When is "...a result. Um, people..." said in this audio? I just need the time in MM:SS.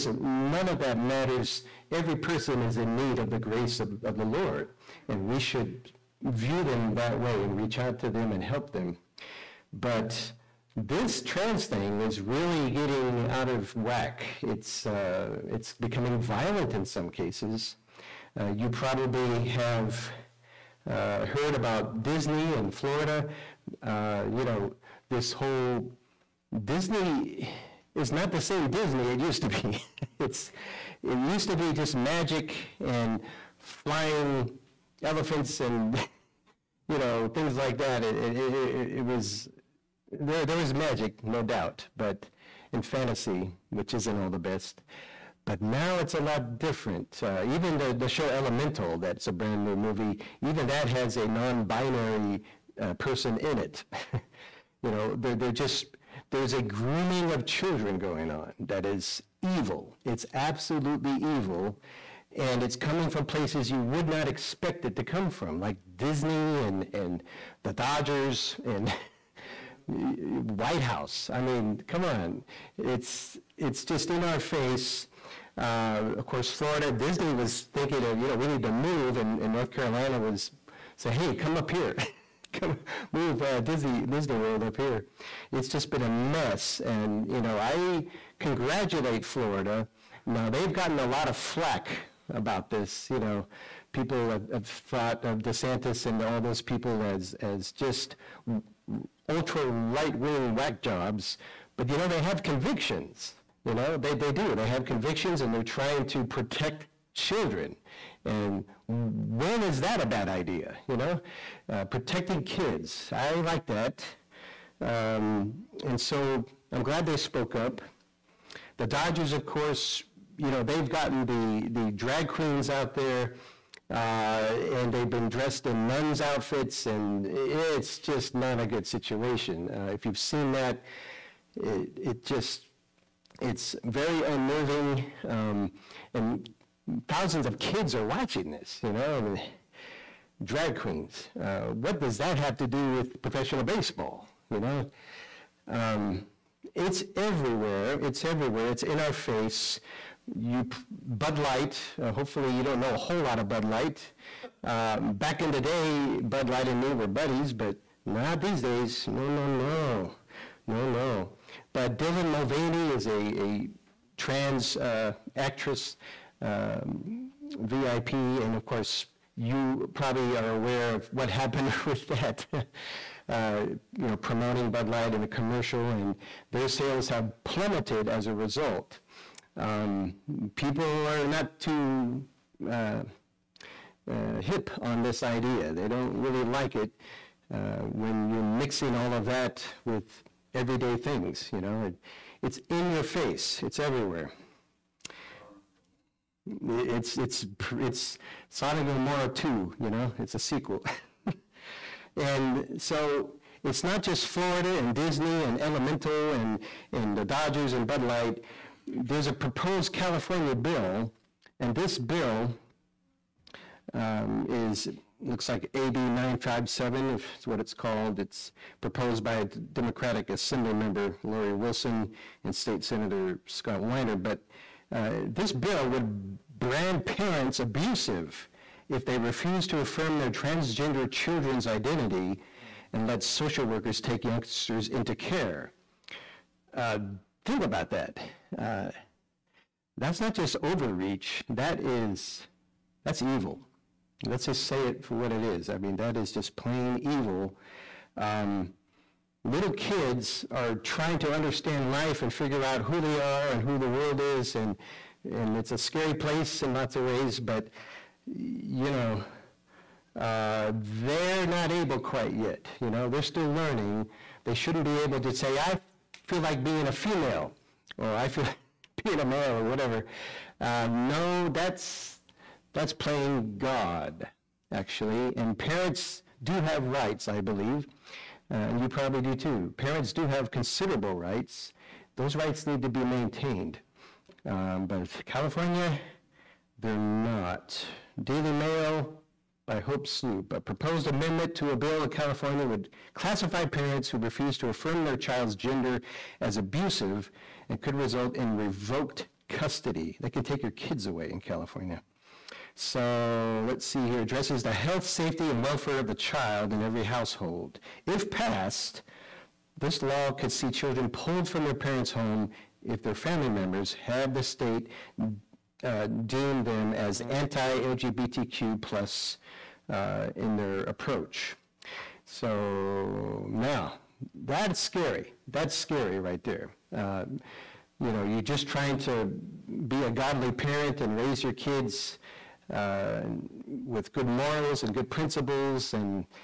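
02:58.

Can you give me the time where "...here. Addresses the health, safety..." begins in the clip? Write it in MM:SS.
05:04.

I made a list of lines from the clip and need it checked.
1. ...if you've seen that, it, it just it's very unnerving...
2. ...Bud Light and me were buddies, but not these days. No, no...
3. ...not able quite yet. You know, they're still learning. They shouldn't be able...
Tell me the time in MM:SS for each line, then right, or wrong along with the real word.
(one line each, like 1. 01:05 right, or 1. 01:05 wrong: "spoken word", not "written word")
1. 02:09 right
2. 02:36 right
3. 04:21 right.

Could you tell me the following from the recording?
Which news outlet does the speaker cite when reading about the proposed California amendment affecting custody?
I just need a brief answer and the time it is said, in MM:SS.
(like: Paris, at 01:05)
Daily Mail, at 04:48.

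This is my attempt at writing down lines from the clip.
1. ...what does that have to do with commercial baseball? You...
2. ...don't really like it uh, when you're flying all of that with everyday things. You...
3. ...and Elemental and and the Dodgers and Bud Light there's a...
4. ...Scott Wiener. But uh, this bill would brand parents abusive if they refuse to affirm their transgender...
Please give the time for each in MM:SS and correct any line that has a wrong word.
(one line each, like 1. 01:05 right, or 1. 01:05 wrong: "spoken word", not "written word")
1. 02:21 wrong: "professional", not "commercial"
2. 03:05 wrong: "mixing", not "flying"
3. 03:25 right
4. 03:43 right.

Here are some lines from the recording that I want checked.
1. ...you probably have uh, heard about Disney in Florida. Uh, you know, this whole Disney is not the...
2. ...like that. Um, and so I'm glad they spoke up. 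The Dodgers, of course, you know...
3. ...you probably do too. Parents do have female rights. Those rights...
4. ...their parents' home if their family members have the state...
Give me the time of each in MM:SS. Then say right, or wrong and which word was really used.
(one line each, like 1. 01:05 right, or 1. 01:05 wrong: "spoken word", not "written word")
1. 00:18 right
2. 01:53 right
3. 04:38 wrong: "considerable", not "female"
4. 05:11 right.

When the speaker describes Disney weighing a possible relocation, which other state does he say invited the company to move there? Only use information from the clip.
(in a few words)
North Carolina.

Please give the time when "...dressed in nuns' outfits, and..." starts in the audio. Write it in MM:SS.
02:05.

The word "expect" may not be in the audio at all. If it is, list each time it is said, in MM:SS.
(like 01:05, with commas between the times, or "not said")
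01:04.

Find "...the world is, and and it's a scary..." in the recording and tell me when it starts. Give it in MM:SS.
04:13.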